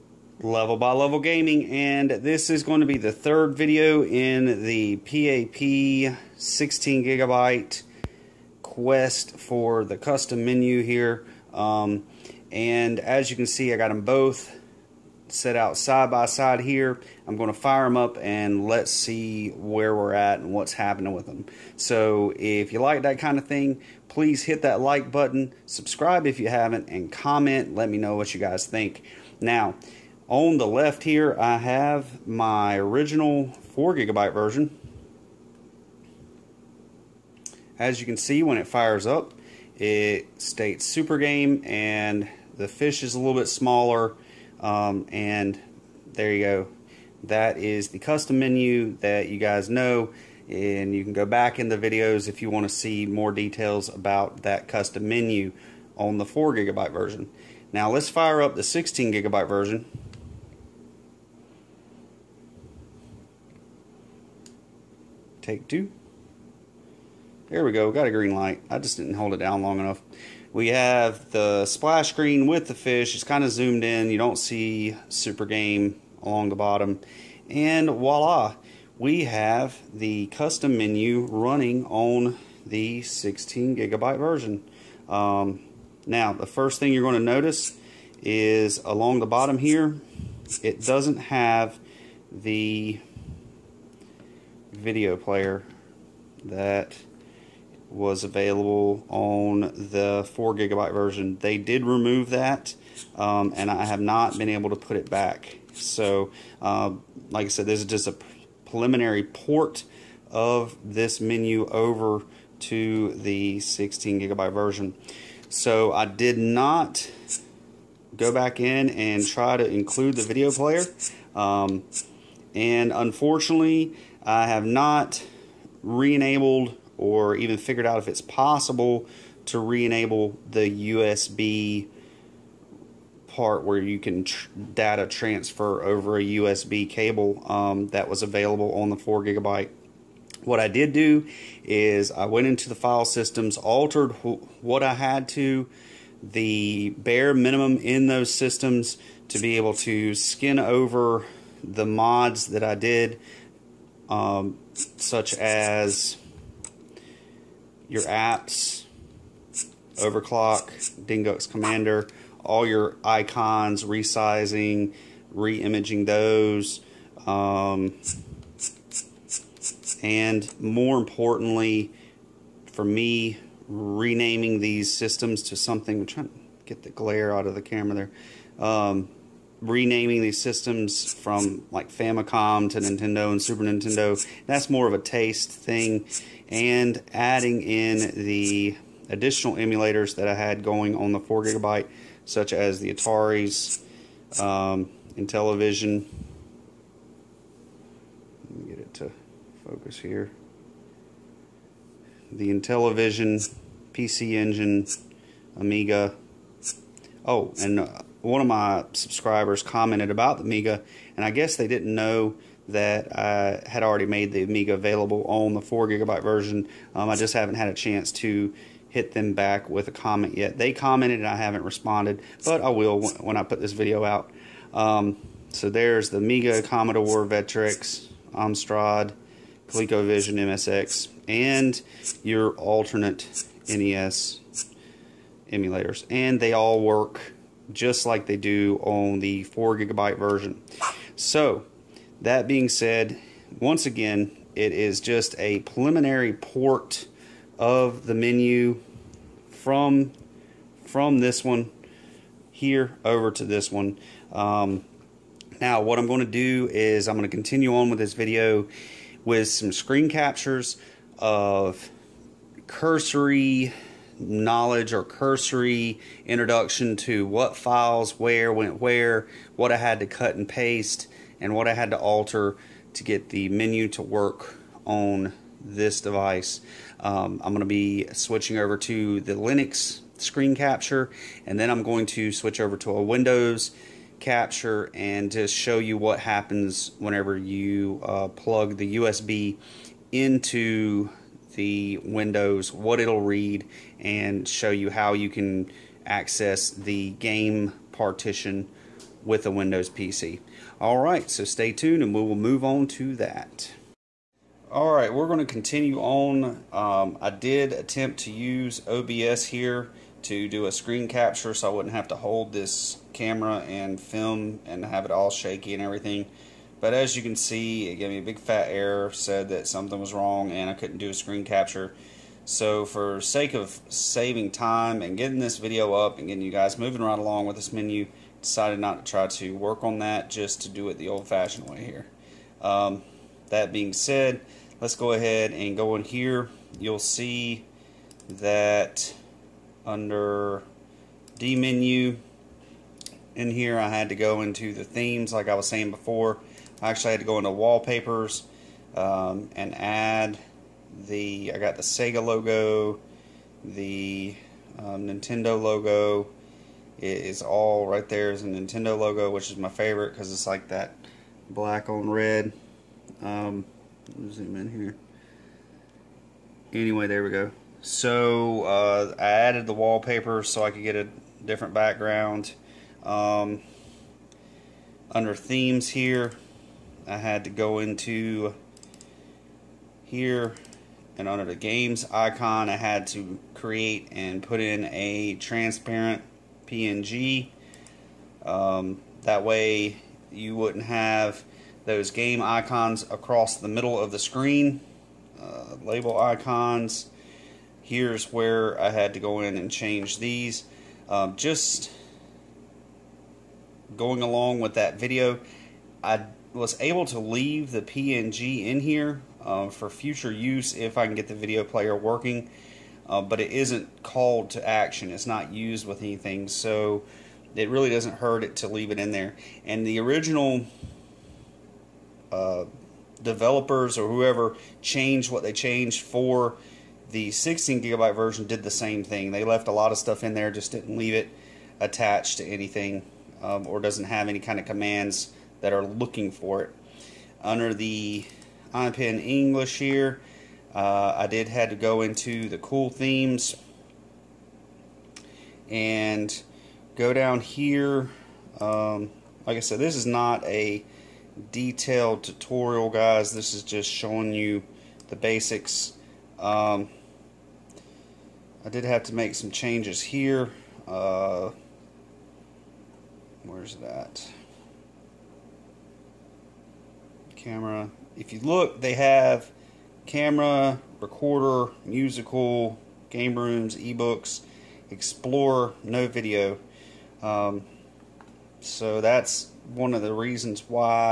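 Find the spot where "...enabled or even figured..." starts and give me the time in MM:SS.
02:06.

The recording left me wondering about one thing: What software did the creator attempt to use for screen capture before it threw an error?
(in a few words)
OBS.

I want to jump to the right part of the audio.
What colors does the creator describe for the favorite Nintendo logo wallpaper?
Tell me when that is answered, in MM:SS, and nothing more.
06:01.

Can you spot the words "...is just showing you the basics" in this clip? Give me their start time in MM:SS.
07:33.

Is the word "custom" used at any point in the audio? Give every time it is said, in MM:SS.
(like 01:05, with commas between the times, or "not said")
00:09, 00:47, 00:54, 01:20.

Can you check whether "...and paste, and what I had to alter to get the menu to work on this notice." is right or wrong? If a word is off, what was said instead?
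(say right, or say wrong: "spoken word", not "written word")
wrong: "device", not "notice".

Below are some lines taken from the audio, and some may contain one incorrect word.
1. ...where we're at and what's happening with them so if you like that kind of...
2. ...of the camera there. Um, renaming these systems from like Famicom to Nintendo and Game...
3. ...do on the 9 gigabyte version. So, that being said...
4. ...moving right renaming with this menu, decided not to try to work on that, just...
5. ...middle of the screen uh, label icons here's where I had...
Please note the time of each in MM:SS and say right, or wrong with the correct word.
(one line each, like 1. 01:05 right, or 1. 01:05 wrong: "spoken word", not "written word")
1. 00:19 right
2. 02:57 wrong: "Super", not "Game"
3. 03:58 wrong: "4", not "9"
4. 05:26 wrong: "along", not "renaming"
5. 06:33 right.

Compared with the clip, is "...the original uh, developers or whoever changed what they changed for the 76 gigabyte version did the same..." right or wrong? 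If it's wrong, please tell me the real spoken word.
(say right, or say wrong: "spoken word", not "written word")
wrong: "16", not "76".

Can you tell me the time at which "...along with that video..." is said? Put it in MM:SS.
06:44.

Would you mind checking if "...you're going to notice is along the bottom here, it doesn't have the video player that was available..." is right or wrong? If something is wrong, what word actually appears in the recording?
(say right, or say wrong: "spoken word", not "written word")
right.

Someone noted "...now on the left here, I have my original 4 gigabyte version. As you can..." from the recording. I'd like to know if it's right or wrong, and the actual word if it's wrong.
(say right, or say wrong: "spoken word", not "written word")
right.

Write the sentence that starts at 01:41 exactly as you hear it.
They did remove that, um, and I have not been able to put it back.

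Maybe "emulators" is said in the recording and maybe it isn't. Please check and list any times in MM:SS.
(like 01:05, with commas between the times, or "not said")
03:09, 03:55.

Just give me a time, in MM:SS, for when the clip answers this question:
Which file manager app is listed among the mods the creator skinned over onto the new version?
02:41.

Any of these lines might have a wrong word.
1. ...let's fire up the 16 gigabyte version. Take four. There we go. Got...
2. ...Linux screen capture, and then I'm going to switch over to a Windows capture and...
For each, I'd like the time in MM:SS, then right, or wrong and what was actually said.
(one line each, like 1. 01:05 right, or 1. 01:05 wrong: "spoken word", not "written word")
1. 00:57 wrong: "two", not "four"
2. 04:39 right.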